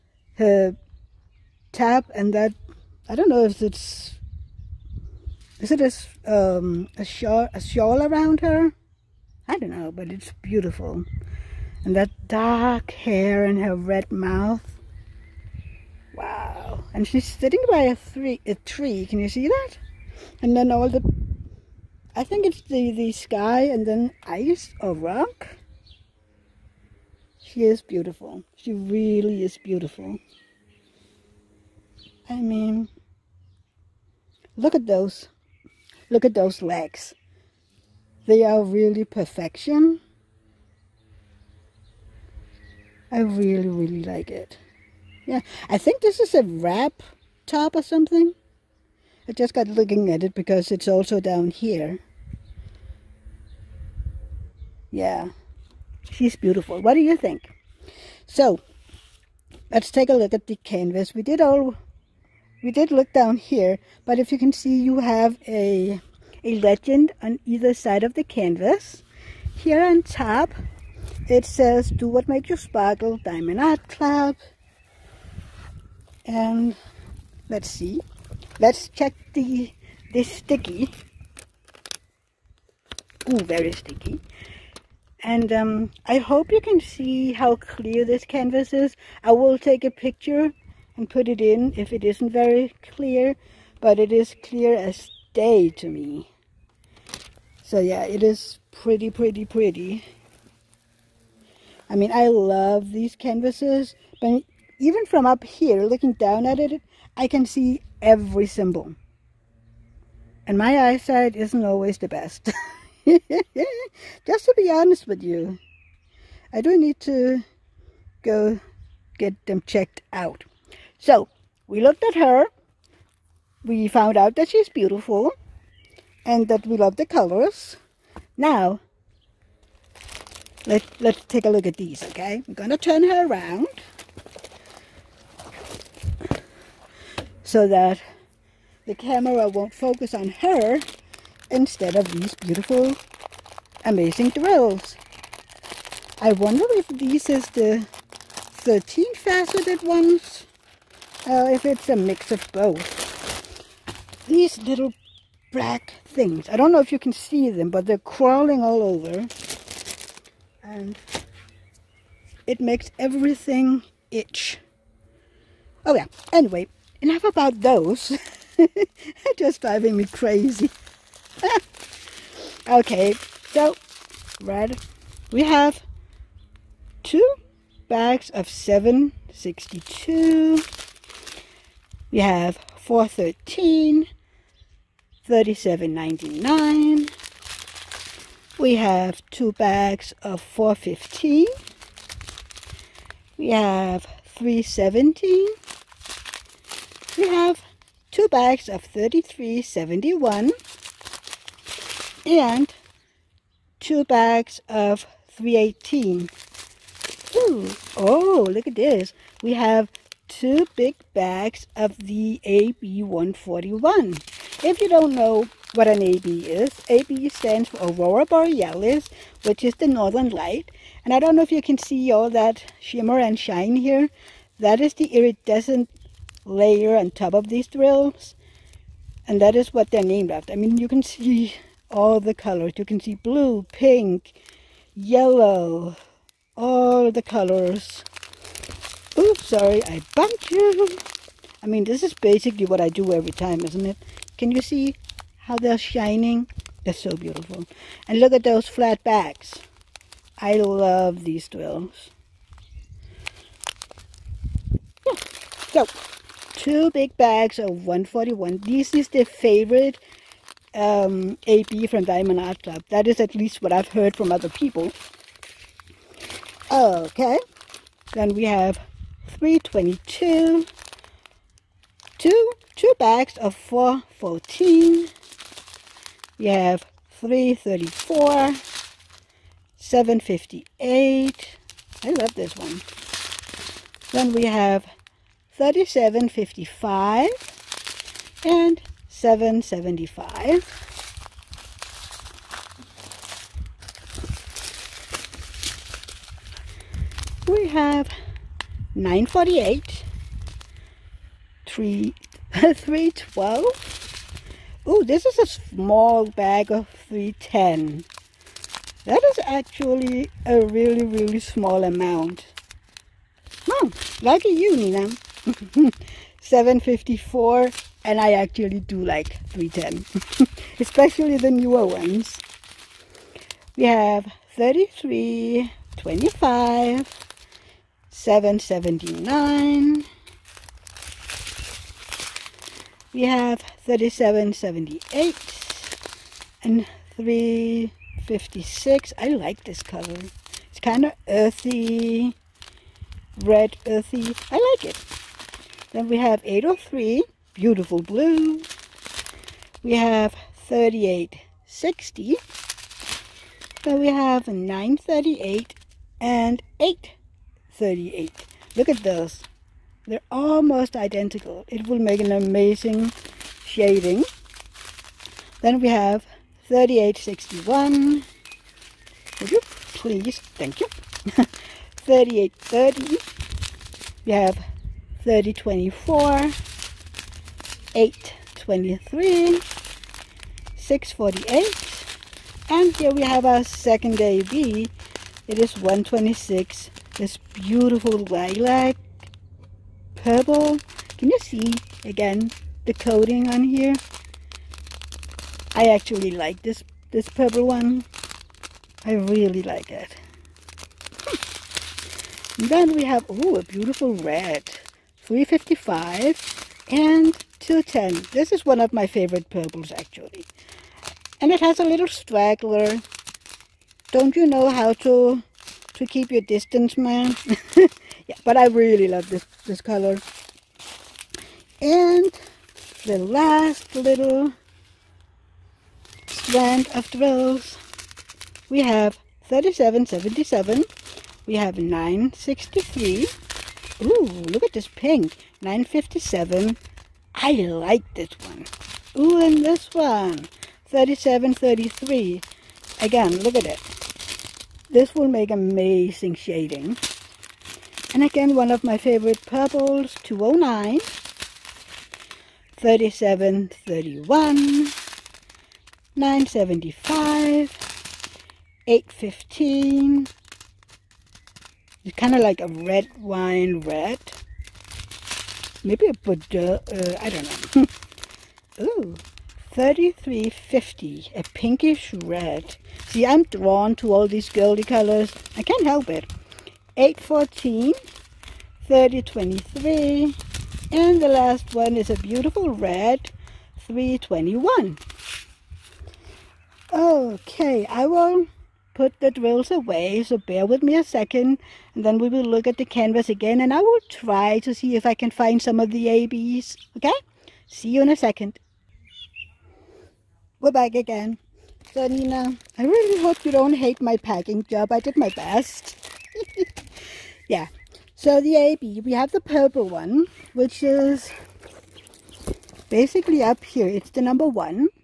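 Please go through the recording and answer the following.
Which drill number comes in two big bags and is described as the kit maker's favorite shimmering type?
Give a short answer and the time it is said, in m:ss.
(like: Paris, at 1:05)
141, at 4:17.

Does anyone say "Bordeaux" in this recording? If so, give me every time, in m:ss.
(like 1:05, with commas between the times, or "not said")
7:46.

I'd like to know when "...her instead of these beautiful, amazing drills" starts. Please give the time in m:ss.
2:20.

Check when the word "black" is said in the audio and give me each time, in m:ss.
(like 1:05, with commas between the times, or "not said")
2:35.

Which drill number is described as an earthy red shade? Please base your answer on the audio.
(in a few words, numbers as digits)
356.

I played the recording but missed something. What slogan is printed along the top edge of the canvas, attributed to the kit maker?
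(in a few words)
Do what makes you sparkle.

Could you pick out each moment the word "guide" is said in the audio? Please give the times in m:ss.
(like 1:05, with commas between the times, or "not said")
not said.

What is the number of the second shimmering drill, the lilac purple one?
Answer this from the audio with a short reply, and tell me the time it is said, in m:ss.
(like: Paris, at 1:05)
126, at 6:25.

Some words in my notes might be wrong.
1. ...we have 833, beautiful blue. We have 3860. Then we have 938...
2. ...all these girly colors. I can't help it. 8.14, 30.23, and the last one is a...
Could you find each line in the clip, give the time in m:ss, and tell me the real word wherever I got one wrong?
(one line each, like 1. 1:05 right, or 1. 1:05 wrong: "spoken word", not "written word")
1. 5:46 wrong: "803", not "833"
2. 7:54 right.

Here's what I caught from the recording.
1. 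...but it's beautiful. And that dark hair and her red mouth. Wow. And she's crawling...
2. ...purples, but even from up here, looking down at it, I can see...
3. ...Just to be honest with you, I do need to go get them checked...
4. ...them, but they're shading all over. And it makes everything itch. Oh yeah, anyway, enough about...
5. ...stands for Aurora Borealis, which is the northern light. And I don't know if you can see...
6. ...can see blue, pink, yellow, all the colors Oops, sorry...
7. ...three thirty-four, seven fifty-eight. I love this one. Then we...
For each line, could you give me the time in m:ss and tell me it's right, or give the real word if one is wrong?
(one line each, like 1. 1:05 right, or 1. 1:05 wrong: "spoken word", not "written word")
1. 0:09 wrong: "sitting", not "crawling"
2. 1:43 wrong: "canvases", not "purples"
3. 1:53 right
4. 2:37 wrong: "crawling", not "shading"
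5. 3:37 right
6. 3:52 right
7. 4:37 right.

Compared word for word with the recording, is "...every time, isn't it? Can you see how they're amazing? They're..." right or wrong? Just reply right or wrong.
wrong.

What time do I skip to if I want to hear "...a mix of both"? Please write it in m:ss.
2:31.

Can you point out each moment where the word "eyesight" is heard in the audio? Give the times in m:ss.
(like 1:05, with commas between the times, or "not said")
1:50.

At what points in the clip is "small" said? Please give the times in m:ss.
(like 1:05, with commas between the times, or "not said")
5:05, 5:11.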